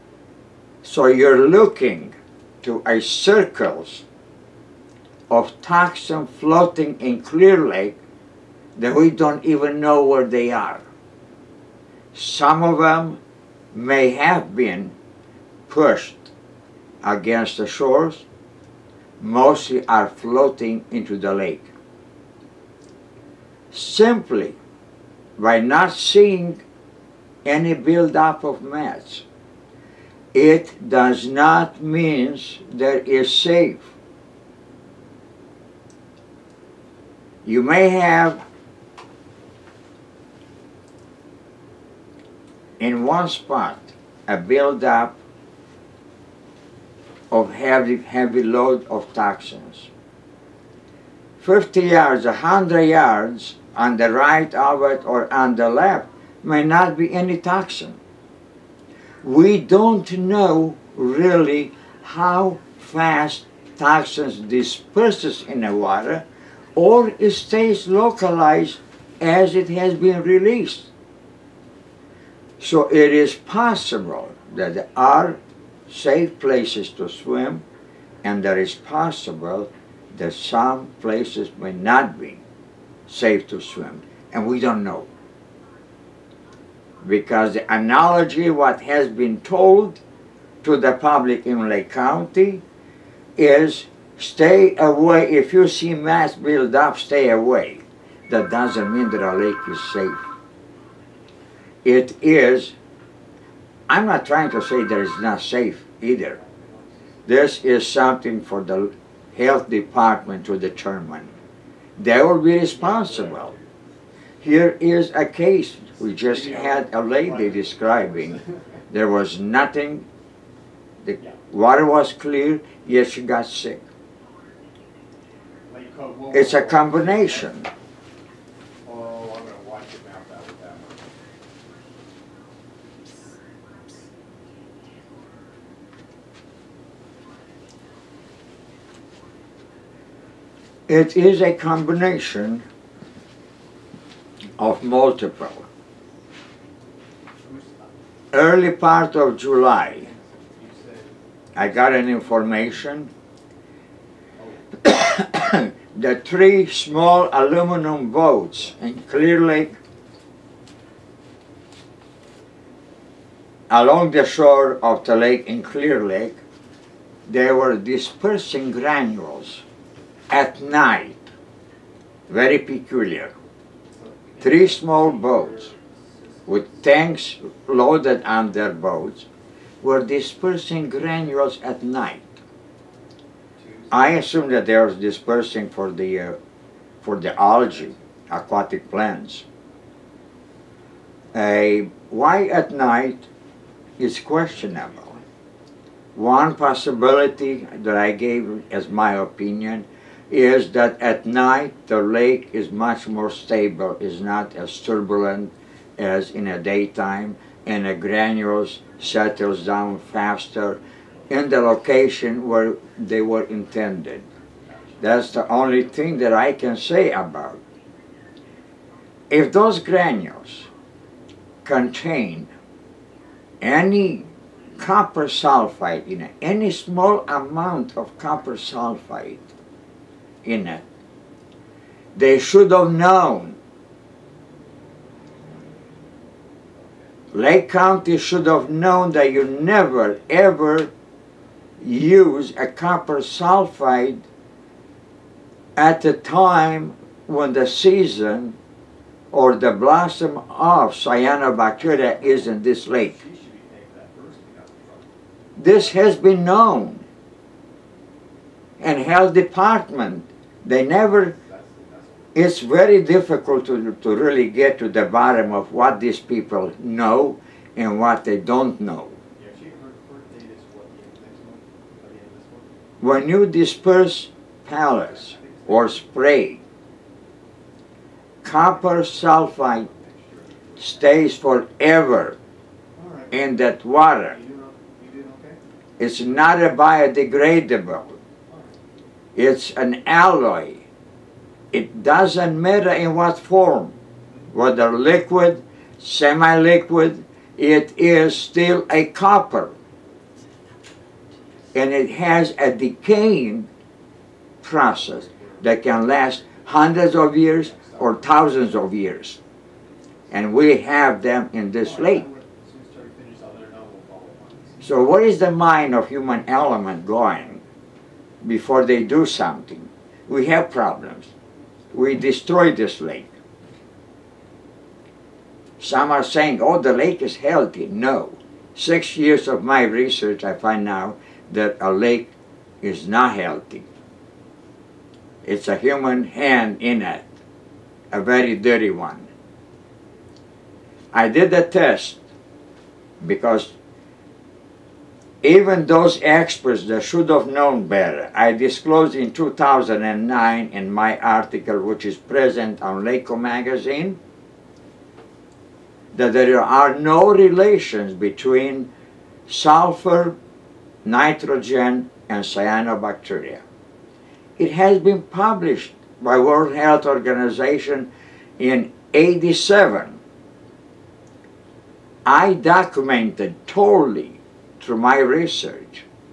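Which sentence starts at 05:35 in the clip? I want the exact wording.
It's a human hand in it, a very dirty one.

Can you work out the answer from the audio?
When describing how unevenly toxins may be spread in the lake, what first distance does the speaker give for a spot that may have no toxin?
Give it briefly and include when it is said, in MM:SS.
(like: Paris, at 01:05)
50 yards, at 00:51.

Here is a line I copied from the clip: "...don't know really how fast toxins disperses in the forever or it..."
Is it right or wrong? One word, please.
wrong.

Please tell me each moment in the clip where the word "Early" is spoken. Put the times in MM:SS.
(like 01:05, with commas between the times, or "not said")
02:28.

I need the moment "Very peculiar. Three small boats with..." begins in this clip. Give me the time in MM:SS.
02:52.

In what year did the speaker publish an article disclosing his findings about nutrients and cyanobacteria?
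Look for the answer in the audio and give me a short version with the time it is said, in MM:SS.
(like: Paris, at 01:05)
2009, at 05:49.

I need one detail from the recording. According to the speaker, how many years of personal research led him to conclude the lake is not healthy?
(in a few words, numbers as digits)
6.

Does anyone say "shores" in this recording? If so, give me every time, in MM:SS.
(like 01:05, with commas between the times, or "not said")
00:17, 02:44.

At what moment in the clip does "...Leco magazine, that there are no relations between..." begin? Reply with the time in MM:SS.
05:53.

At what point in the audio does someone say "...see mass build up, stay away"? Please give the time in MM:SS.
01:35.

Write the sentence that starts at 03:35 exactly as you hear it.
That's the only thing that I can say about.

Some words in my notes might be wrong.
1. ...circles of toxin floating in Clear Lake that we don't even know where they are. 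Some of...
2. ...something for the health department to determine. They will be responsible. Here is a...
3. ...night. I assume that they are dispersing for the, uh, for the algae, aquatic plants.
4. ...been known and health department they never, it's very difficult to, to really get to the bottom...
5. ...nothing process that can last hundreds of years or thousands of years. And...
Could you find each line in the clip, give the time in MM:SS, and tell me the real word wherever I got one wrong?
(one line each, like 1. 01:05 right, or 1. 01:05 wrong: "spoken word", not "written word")
1. 00:03 right
2. 01:47 right
3. 03:01 right
4. 04:16 right
5. 05:02 wrong: "decaying", not "nothing".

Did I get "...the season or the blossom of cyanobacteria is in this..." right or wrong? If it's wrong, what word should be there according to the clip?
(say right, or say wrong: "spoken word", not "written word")
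right.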